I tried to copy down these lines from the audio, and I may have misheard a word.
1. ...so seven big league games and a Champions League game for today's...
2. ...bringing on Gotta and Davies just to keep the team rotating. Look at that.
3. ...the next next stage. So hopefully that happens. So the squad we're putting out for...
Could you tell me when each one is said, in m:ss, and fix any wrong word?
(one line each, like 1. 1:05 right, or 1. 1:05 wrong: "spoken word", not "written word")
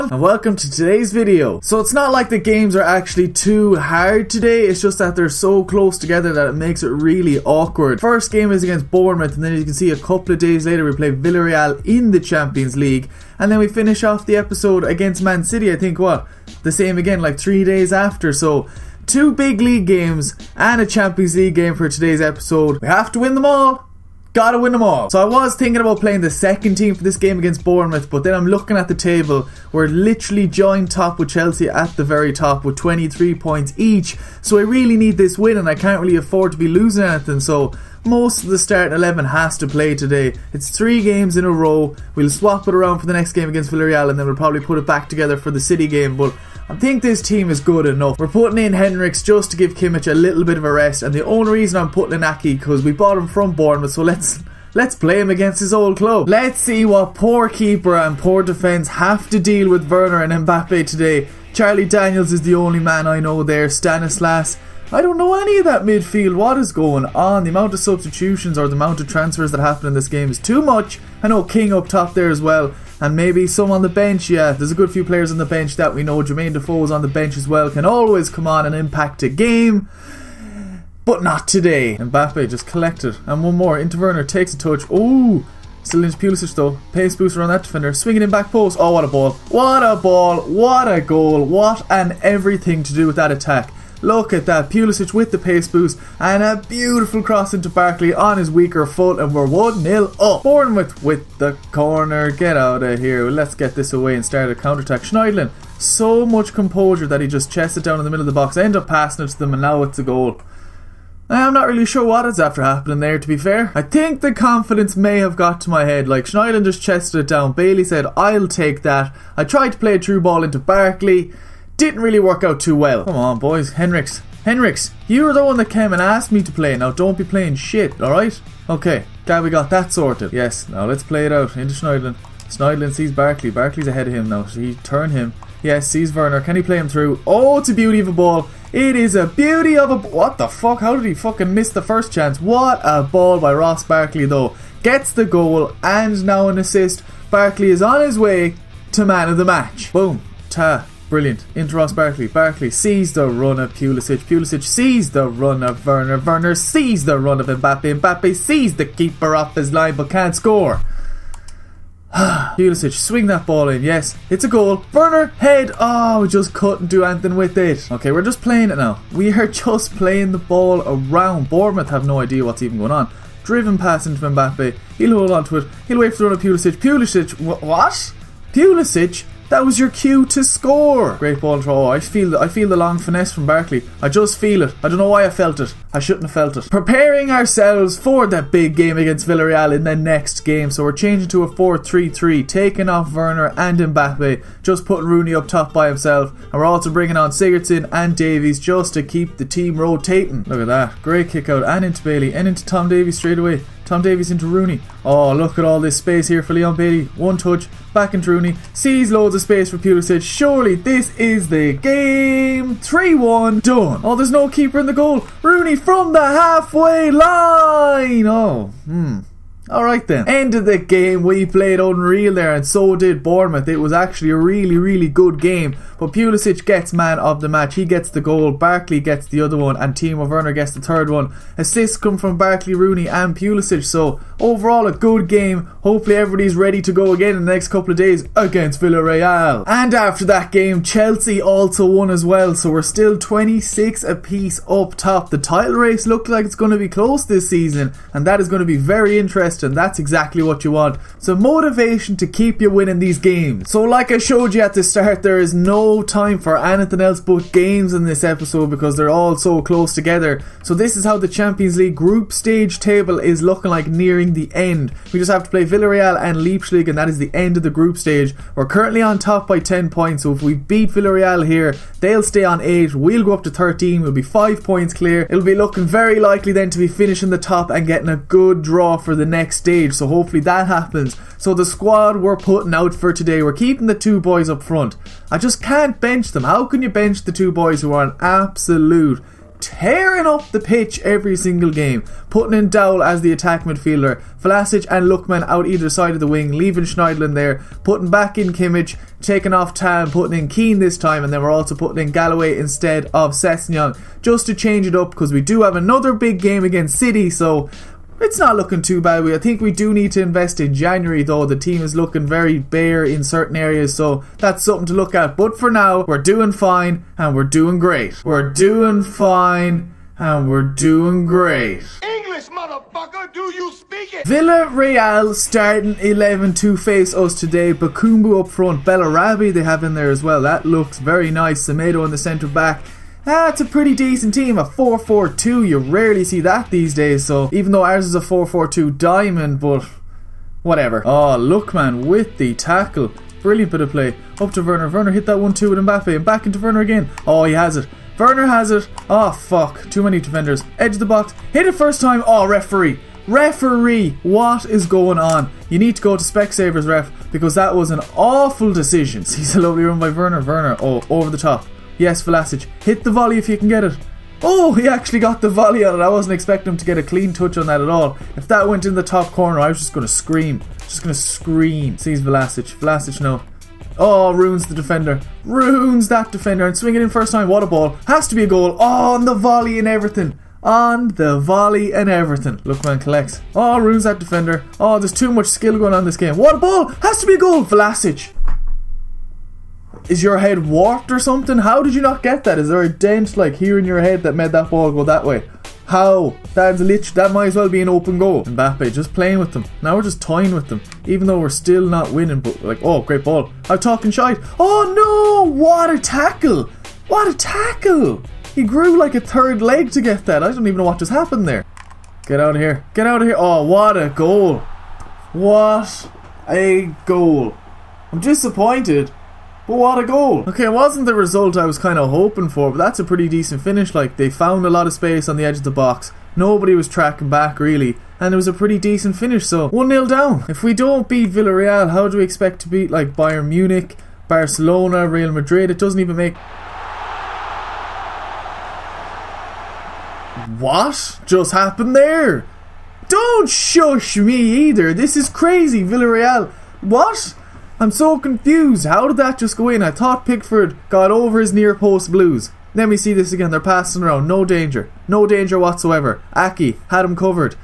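1. 0:18 wrong: "two", not "seven"
2. 3:16 wrong: "Sigurdsson", not "Gotta"
3. 4:39 right.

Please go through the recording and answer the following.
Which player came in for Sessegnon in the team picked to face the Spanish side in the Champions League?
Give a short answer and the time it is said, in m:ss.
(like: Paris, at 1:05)
Galloway, at 5:02.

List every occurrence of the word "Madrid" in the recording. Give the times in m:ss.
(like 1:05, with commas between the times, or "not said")
7:15.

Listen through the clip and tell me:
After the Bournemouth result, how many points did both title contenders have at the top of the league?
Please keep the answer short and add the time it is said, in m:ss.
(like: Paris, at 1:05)
26, at 4:03.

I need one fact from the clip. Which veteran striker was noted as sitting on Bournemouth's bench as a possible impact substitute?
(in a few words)
Jermaine Defoe.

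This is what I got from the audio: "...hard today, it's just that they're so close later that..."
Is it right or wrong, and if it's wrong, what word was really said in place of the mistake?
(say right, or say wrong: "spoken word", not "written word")
wrong: "together", not "later".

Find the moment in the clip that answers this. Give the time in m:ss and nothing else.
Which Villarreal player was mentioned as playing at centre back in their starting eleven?
5:31.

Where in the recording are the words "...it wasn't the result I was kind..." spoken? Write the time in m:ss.
7:00.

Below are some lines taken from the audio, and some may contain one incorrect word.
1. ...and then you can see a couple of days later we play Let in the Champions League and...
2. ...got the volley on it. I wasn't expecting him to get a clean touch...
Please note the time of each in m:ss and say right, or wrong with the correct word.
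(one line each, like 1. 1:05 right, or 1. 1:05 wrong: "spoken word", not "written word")
1. 0:09 wrong: "Villarreal", not "Let"
2. 6:05 right.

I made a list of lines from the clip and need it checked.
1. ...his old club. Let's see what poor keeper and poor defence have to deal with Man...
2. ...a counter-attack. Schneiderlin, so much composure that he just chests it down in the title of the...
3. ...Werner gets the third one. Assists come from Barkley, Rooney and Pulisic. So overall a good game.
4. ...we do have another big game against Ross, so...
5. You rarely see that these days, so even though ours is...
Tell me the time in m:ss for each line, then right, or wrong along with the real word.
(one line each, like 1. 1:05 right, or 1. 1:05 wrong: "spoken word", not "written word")
1. 0:55 wrong: "Werner", not "Man"
2. 1:44 wrong: "middle", not "title"
3. 3:50 right
4. 5:05 wrong: "City", not "Ross"
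5. 5:35 right.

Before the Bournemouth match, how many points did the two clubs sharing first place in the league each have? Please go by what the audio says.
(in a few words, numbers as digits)
23.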